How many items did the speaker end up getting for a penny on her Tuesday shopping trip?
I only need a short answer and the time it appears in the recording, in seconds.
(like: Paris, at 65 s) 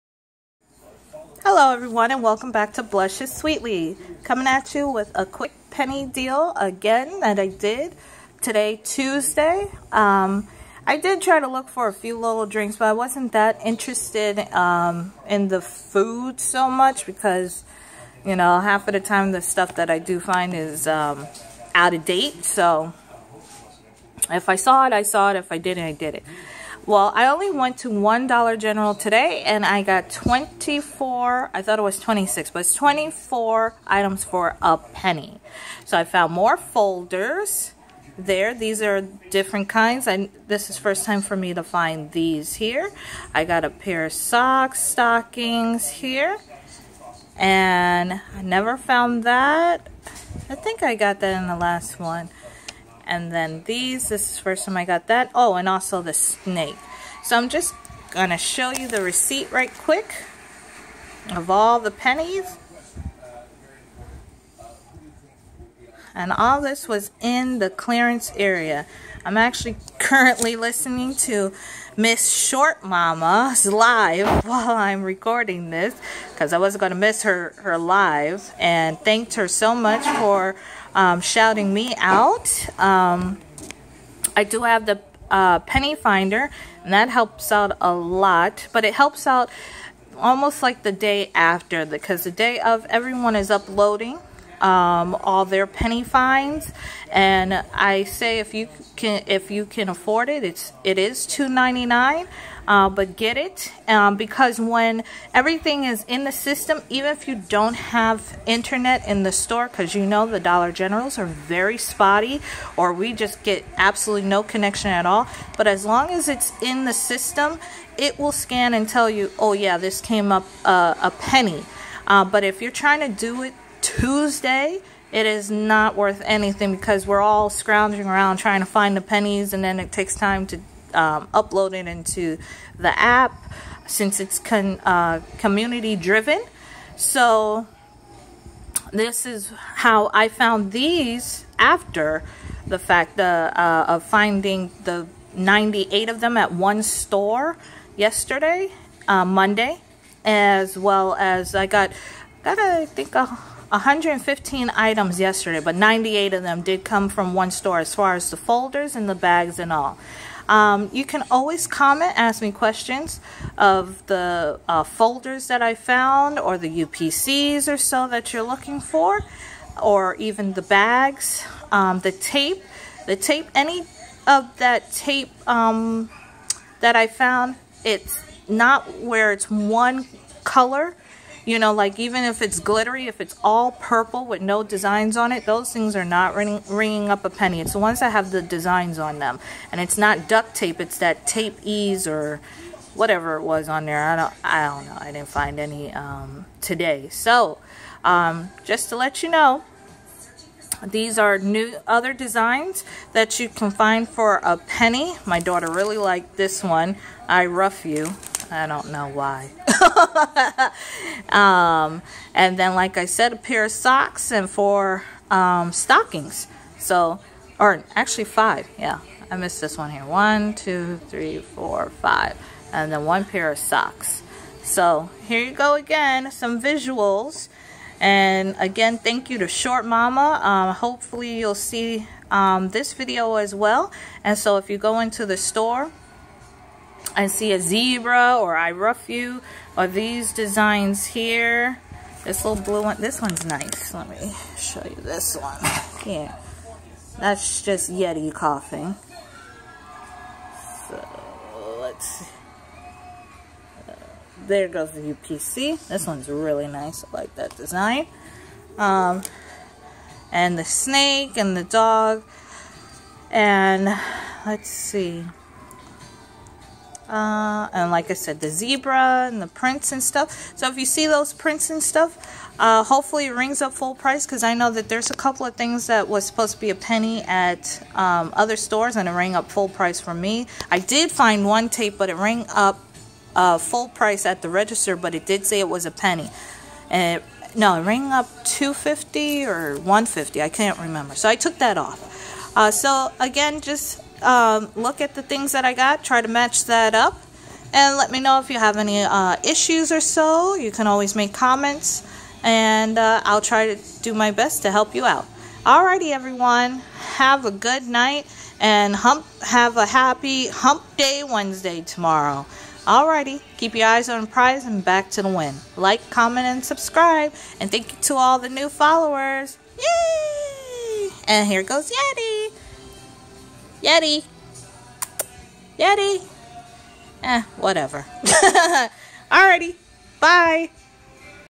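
24, at 32 s.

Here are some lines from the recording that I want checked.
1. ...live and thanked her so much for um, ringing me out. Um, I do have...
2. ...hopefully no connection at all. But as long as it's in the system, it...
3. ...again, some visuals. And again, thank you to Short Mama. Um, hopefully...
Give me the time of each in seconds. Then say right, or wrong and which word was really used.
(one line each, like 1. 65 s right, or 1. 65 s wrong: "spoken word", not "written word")
1. 77 s wrong: "shouting", not "ringing"
2. 113 s wrong: "absolutely", not "hopefully"
3. 225 s right.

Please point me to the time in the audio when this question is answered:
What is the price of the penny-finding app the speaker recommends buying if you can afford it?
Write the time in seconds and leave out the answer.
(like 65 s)
101 s.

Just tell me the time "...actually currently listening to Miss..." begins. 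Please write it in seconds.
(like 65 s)
69 s.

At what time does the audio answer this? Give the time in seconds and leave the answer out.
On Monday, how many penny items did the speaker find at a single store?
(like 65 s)
145 s.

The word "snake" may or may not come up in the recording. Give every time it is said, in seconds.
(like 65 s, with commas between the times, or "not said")
56 s, 260 s.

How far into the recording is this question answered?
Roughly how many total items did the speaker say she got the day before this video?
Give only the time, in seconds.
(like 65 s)
153 s.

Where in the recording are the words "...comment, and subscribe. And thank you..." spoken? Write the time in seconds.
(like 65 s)
316 s.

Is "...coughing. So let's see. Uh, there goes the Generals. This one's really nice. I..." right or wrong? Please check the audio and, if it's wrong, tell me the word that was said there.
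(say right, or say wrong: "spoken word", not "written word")
wrong: "UPC", not "Generals".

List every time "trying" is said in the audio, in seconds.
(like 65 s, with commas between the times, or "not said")
122 s, 128 s.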